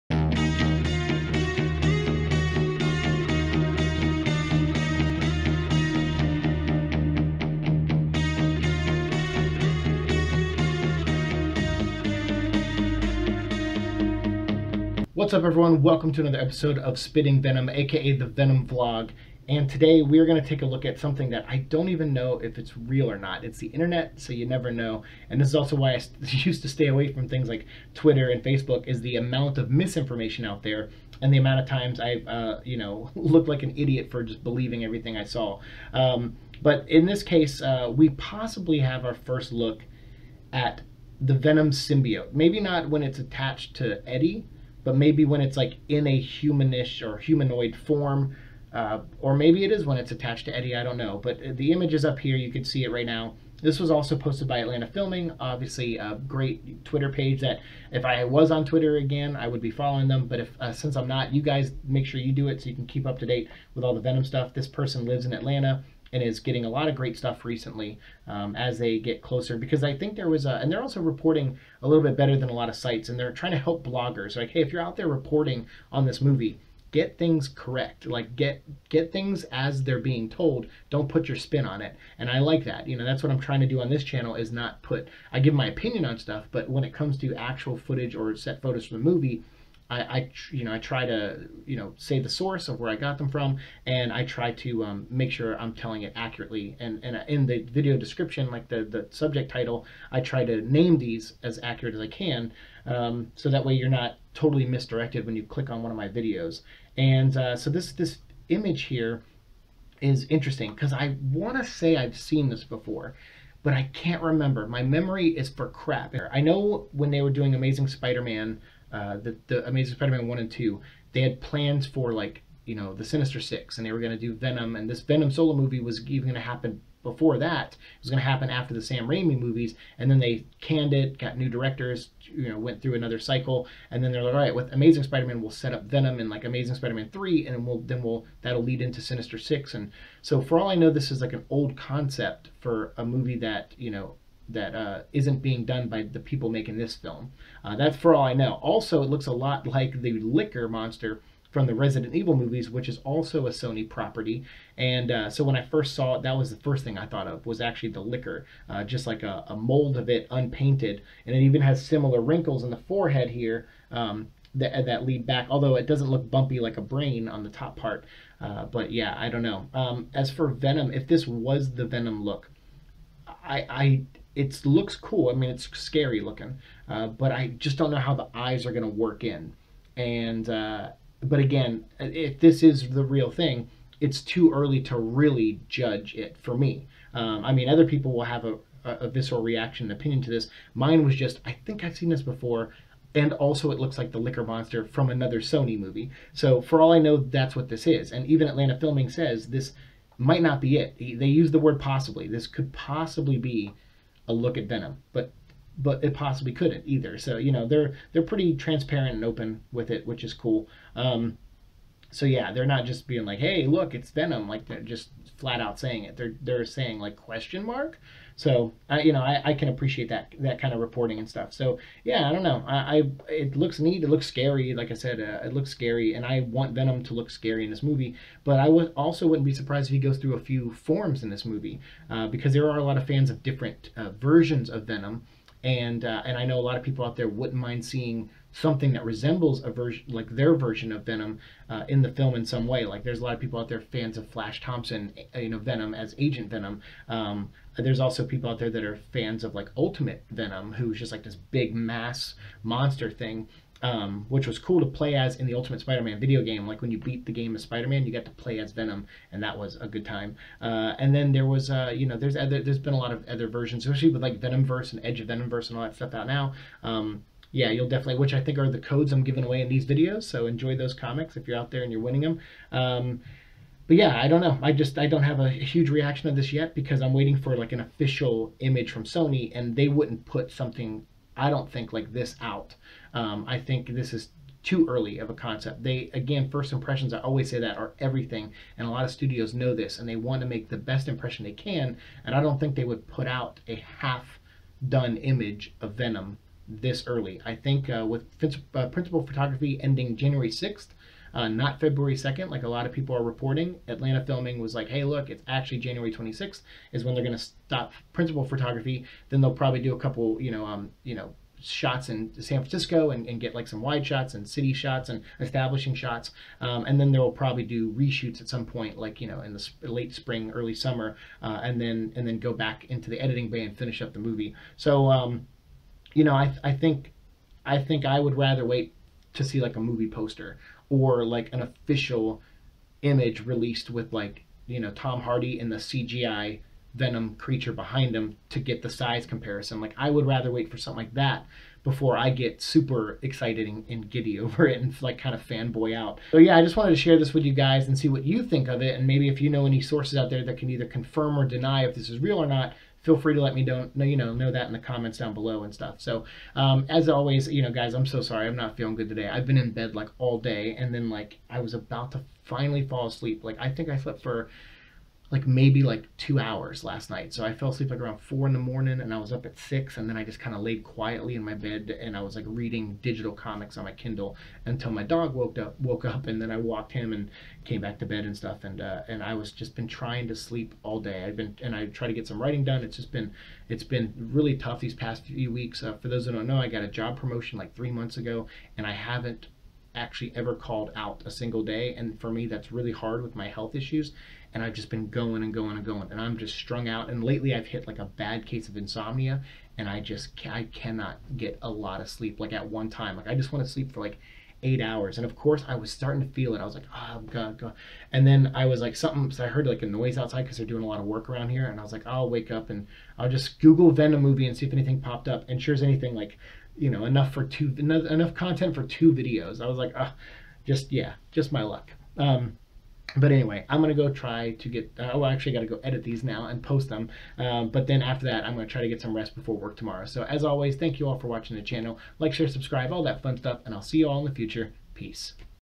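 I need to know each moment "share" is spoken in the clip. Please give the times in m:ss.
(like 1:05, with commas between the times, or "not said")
5:47, 7:12.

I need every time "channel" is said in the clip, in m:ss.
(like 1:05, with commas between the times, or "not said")
1:24, 7:11.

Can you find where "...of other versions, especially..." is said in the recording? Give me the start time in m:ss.
4:23.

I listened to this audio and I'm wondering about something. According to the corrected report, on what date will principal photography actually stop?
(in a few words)
January 26th.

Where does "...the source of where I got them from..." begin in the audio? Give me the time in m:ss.
1:32.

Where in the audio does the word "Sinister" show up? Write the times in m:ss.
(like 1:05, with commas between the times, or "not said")
2:03, 2:19.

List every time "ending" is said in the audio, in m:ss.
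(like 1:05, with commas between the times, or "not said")
4:59.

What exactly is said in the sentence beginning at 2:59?
And uh, but again, if this is the real thing, it's too early to really judge it for me.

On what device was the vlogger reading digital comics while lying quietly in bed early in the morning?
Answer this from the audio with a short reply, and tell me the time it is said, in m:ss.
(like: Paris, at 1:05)
Kindle, at 6:13.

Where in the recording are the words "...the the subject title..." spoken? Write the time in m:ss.
1:38.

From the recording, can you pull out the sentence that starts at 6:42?
Like at one time, like I just want to sleep for like eight hours.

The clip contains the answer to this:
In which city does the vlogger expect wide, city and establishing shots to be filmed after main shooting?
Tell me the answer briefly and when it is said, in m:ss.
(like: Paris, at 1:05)
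San Francisco, at 5:12.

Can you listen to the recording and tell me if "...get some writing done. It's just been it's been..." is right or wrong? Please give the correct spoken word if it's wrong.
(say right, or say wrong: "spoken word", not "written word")
right.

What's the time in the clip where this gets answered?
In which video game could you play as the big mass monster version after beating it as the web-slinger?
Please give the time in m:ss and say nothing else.
4:15.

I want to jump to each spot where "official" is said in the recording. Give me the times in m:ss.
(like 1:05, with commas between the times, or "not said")
4:37, 5:31.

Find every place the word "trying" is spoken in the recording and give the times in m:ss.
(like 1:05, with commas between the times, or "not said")
1:13, 1:23, 6:19.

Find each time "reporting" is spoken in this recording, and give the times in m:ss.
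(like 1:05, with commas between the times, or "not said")
1:11, 1:15, 3:40, 5:03.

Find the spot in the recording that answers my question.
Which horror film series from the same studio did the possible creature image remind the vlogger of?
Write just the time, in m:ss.
2:31.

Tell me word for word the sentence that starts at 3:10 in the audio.
Mine was just, I think I've seen this before.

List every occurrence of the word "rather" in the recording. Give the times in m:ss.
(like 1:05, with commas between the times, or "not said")
5:28, 5:40.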